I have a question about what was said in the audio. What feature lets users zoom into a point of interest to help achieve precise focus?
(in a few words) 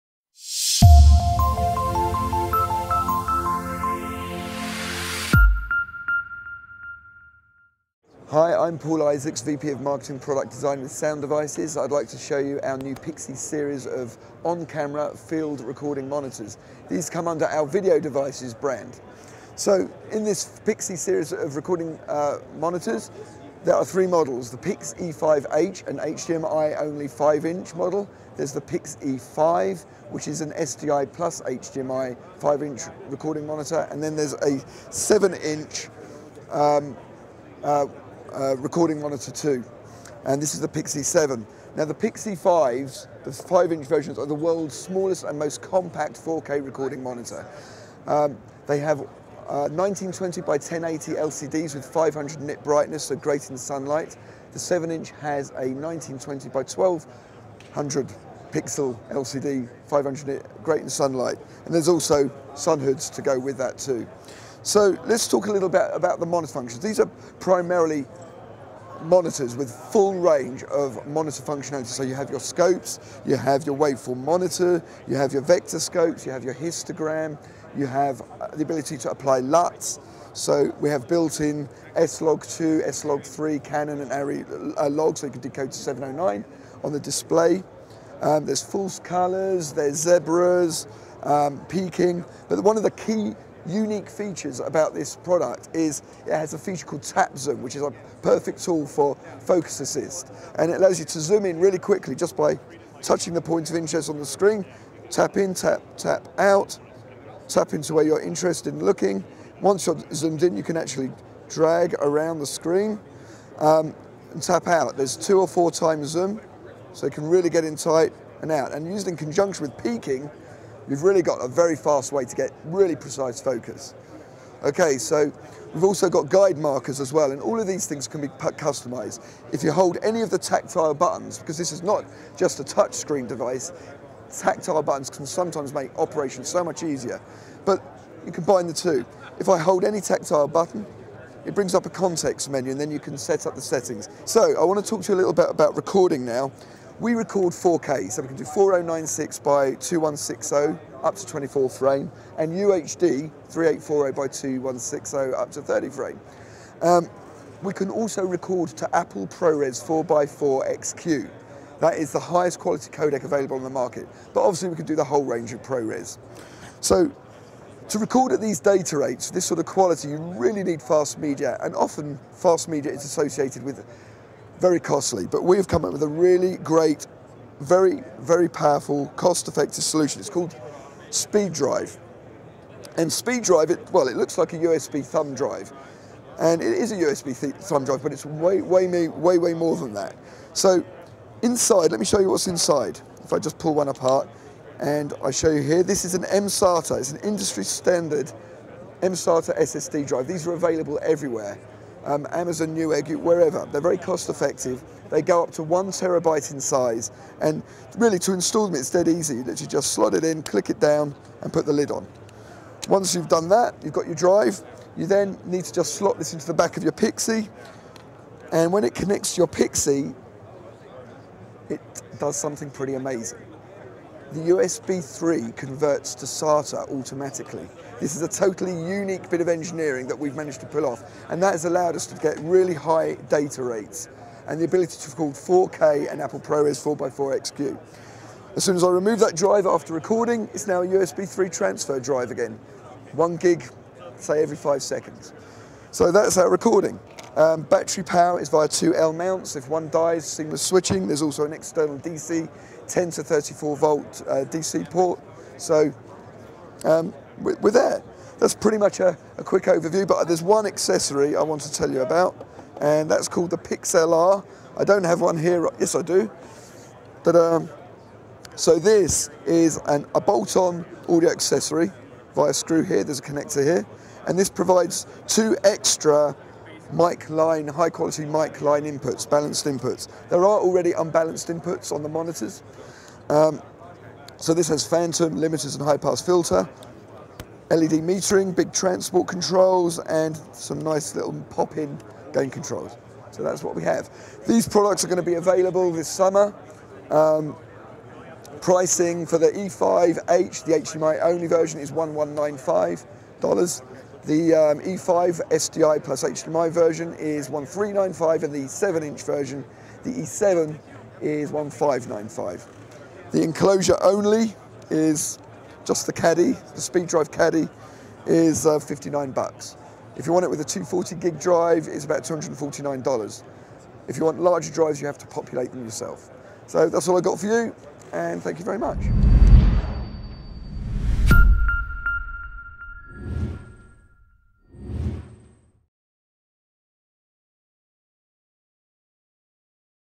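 Tap Zoom.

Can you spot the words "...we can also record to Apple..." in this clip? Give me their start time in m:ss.
2:37.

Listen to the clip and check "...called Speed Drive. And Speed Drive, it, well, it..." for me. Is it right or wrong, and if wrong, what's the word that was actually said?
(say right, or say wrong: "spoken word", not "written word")
right.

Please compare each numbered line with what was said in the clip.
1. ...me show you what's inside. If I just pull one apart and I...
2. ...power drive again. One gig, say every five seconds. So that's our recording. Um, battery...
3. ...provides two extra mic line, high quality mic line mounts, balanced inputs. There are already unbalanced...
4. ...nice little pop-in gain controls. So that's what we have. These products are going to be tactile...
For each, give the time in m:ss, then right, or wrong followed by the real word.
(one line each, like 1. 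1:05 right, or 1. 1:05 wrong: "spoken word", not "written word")
1. 3:11 right
2. 4:01 wrong: "transfer", not "power"
3. 4:34 wrong: "inputs", not "mounts"
4. 4:50 wrong: "available", not "tactile".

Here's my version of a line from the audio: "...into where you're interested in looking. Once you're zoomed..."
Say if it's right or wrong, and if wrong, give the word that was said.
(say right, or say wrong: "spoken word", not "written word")
right.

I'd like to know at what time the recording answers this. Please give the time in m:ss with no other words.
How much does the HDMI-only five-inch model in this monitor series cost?
5:01.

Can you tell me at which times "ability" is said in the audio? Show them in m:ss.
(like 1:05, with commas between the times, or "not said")
1:18, 3:54.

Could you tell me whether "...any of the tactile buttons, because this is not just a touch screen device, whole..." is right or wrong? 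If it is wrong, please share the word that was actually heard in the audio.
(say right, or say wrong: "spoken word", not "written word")
wrong: "tactile", not "whole".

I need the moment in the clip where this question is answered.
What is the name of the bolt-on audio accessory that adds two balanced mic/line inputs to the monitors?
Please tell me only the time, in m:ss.
4:23.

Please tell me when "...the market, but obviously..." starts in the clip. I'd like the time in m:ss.
2:43.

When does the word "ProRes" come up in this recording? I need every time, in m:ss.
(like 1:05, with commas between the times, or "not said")
2:39, 2:45, 3:56.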